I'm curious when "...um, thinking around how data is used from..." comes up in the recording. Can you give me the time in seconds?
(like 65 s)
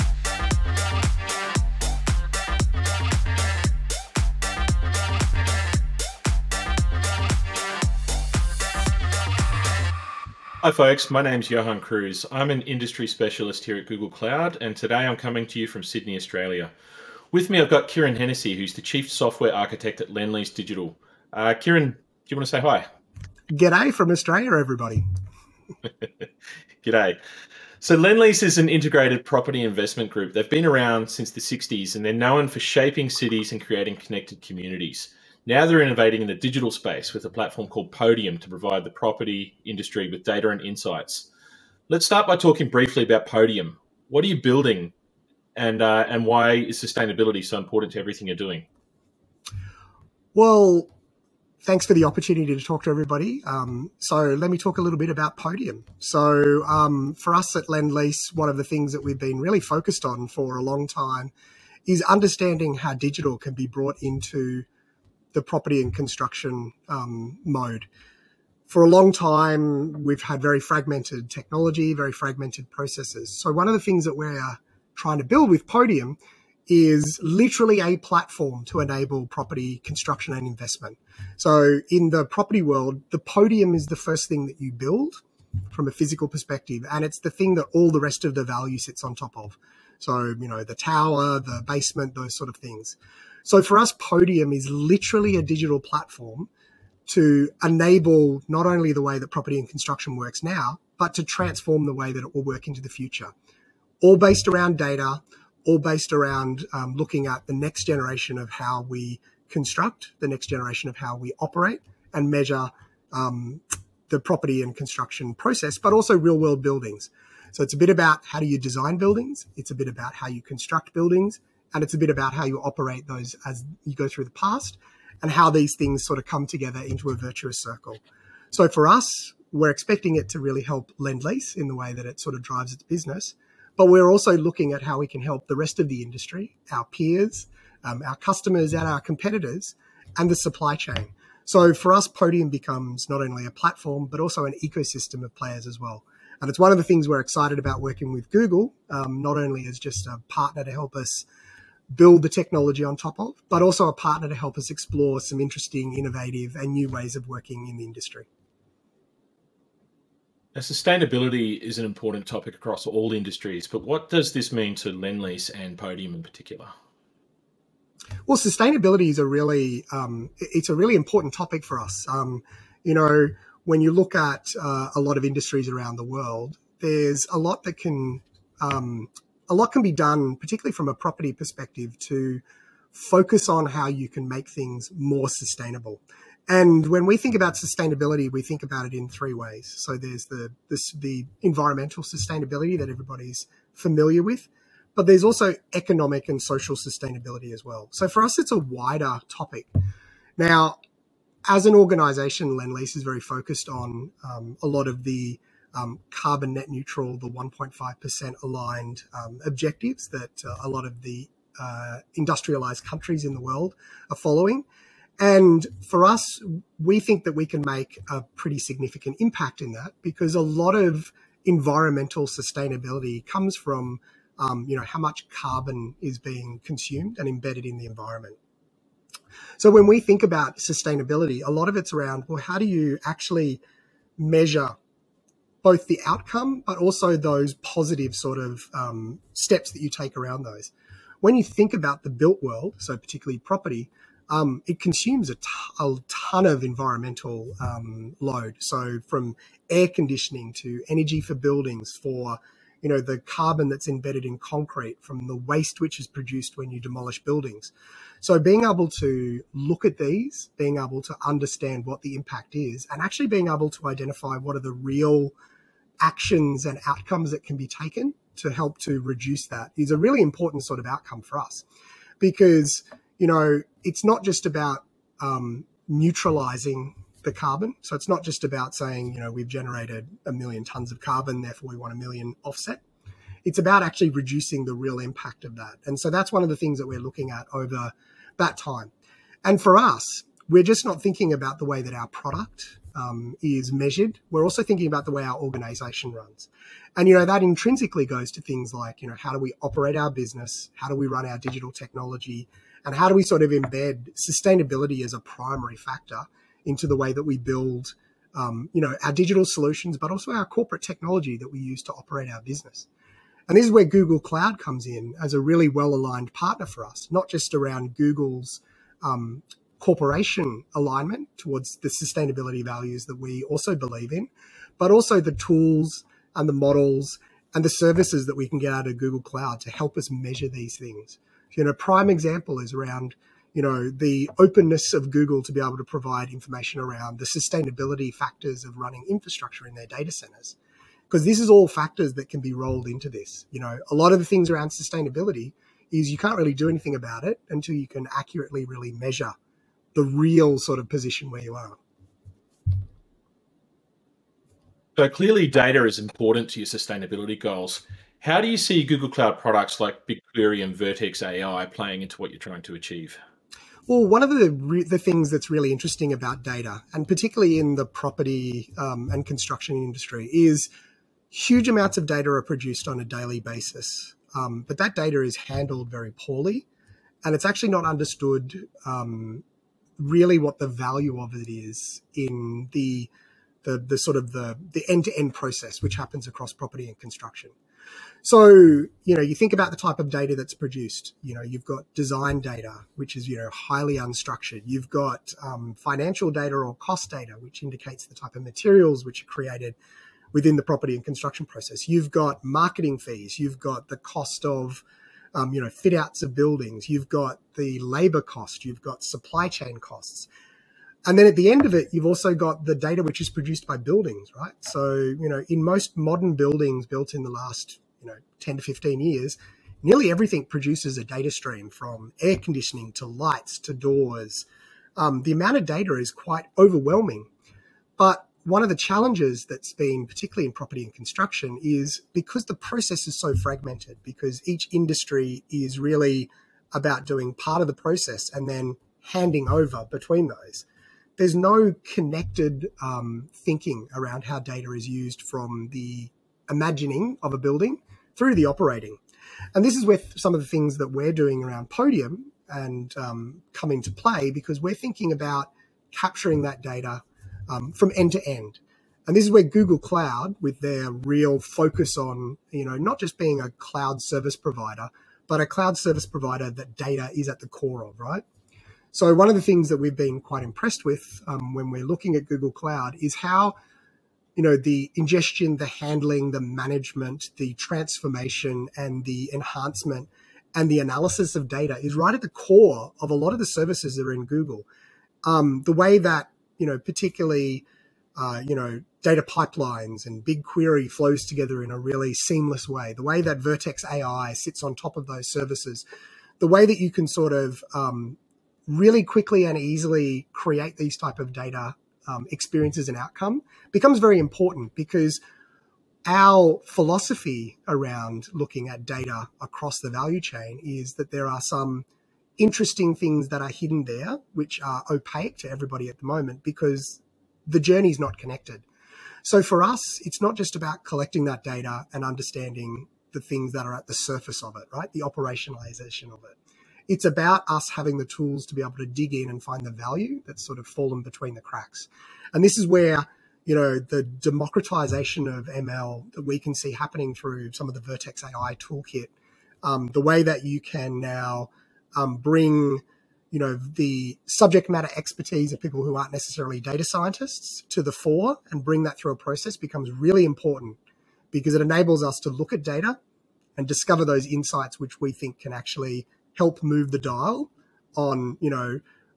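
442 s.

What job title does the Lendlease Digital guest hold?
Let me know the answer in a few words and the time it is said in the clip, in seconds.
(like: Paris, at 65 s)
Chief Software Architect, at 18 s.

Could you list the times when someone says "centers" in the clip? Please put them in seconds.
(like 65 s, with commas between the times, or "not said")
340 s.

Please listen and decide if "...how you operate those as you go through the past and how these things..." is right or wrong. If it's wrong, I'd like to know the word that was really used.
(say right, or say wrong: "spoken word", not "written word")
right.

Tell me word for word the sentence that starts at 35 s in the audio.
Now they're innovating in the digital space with a platform called Podium to provide the property industry with data and insights.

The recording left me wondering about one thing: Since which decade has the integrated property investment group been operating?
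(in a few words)
the 60s.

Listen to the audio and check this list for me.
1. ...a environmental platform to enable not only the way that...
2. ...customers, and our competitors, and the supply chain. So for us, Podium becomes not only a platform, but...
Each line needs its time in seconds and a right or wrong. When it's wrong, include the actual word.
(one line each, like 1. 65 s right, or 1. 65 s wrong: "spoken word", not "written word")
1. 95 s wrong: "digital", not "environmental"
2. 138 s right.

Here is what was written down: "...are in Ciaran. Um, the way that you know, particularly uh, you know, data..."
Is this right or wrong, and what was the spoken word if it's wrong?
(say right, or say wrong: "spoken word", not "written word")
wrong: "Google", not "Ciaran".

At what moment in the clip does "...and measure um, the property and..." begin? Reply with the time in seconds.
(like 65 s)
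112 s.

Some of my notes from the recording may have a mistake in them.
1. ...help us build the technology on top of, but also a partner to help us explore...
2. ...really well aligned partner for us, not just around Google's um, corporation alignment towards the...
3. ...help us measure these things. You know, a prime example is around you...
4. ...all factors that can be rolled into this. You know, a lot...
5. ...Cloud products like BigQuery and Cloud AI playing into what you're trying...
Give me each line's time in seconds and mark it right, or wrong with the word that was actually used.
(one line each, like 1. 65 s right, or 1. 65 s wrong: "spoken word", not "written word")
1. 150 s right
2. 315 s right
3. 329 s right
4. 341 s right
5. 359 s wrong: "Vertex", not "Cloud".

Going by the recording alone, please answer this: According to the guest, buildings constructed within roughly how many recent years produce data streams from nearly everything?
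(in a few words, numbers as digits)
10 to 15 years.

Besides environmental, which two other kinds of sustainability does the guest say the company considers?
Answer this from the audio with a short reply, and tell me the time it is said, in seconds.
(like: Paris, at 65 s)
economic and social, at 195 s.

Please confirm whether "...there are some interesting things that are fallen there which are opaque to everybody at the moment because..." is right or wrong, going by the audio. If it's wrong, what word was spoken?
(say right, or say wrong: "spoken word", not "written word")
wrong: "hidden", not "fallen".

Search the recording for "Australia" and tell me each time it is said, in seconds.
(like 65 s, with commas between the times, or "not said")
16 s, 24 s.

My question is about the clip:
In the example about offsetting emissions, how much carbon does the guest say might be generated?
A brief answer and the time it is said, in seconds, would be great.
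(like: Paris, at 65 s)
a million tons, at 280 s.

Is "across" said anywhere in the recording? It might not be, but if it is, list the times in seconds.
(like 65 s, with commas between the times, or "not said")
162 s, 386 s, 509 s.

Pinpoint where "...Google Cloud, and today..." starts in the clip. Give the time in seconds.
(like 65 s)
13 s.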